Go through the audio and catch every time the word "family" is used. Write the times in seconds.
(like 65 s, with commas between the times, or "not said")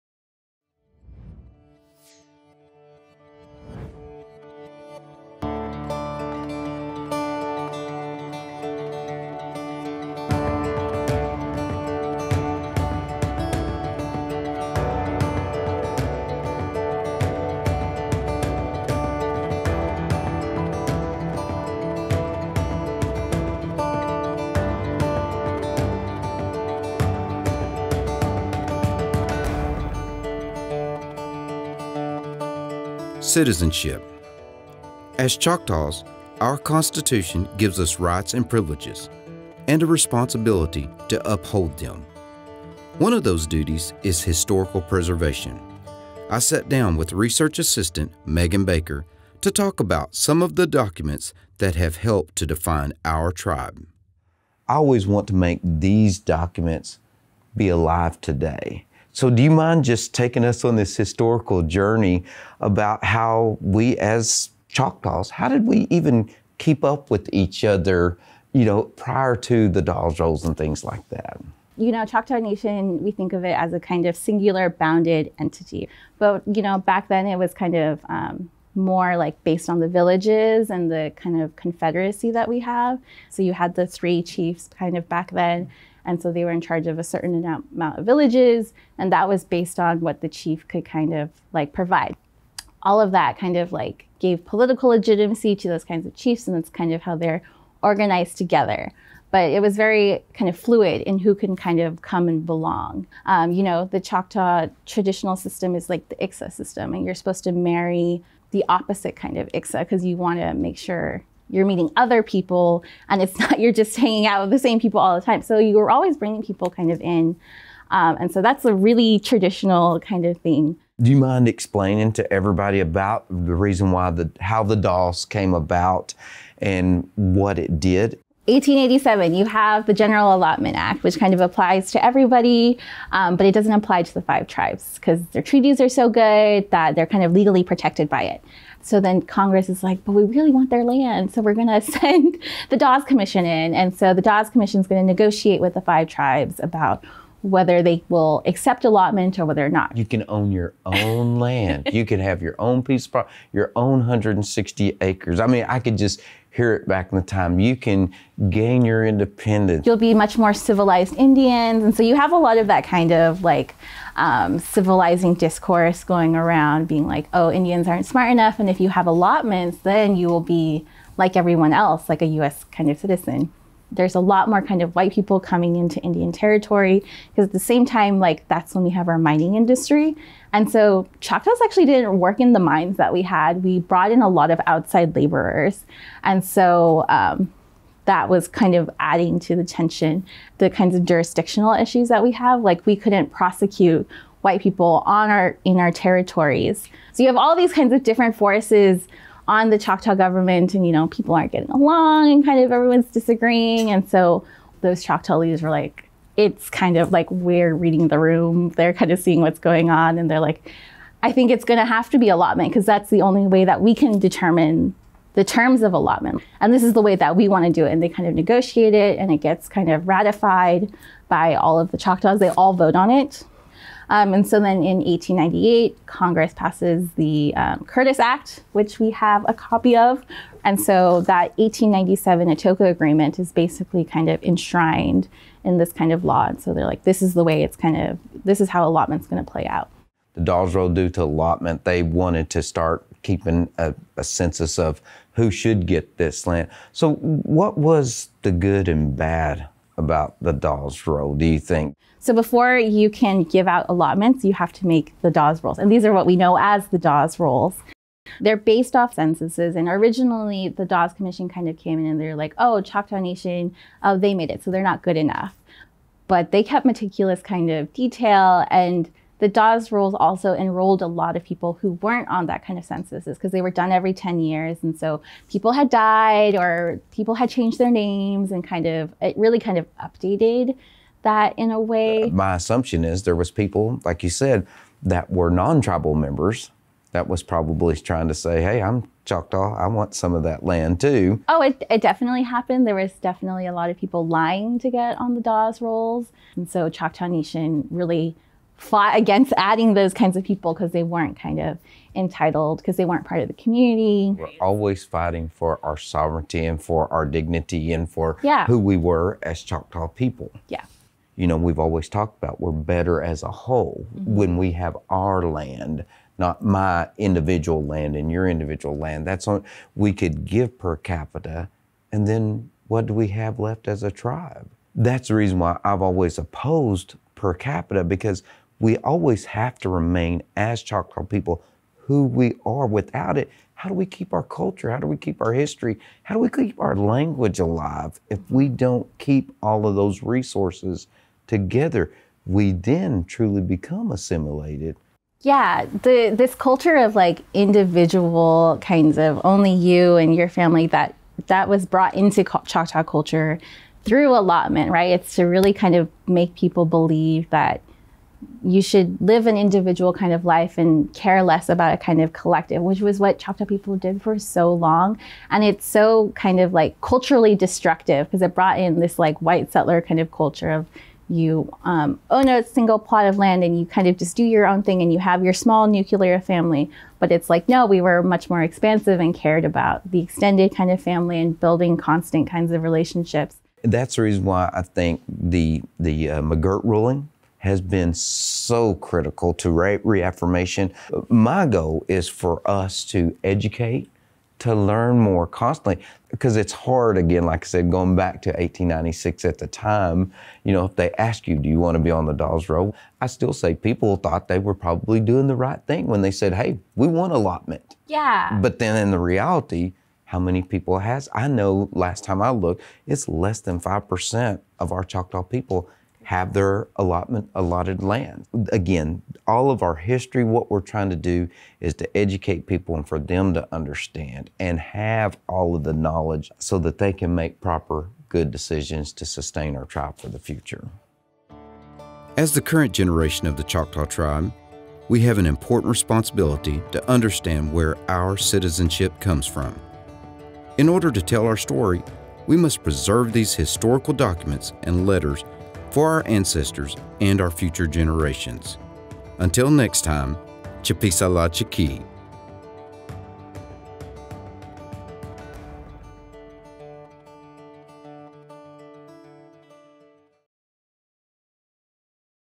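350 s, 376 s, 381 s.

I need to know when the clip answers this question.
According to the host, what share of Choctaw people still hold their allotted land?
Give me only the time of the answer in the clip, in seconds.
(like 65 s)
413 s.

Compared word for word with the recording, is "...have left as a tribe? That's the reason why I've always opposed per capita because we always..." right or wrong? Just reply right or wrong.
right.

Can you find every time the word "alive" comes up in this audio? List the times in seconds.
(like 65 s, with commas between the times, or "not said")
57 s, 337 s.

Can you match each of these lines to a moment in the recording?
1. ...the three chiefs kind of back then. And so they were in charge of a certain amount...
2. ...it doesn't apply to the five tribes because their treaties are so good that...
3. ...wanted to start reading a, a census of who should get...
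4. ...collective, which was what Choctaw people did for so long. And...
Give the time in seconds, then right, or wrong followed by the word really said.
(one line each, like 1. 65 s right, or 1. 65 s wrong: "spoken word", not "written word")
1. 83 s right
2. 133 s right
3. 242 s wrong: "keeping", not "reading"
4. 362 s right.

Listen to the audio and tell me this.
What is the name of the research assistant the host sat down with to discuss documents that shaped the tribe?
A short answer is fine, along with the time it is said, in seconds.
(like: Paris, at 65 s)
Megan Baker, at 48 s.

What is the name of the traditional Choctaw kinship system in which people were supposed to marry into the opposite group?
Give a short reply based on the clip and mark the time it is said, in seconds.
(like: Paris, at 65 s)
Iksa system, at 106 s.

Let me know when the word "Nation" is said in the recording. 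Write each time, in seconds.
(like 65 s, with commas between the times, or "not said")
72 s, 263 s, 297 s.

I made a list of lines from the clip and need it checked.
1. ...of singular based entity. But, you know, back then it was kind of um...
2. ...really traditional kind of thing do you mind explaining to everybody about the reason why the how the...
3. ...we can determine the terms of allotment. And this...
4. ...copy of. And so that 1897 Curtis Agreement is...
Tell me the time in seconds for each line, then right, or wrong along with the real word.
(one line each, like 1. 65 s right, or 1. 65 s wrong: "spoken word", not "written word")
1. 74 s wrong: "bounded", not "based"
2. 118 s right
3. 213 s right
4. 229 s wrong: "Atoka", not "Curtis".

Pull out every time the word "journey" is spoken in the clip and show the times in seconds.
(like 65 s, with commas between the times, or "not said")
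61 s.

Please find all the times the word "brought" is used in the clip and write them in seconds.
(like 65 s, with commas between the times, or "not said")
183 s, 351 s, 368 s.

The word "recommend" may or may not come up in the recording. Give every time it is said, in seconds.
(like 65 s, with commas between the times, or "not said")
not said.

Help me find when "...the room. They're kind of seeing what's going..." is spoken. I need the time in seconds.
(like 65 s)
208 s.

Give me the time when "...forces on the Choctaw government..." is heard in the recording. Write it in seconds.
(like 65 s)
198 s.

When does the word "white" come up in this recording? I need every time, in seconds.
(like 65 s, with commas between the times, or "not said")
174 s, 194 s, 369 s.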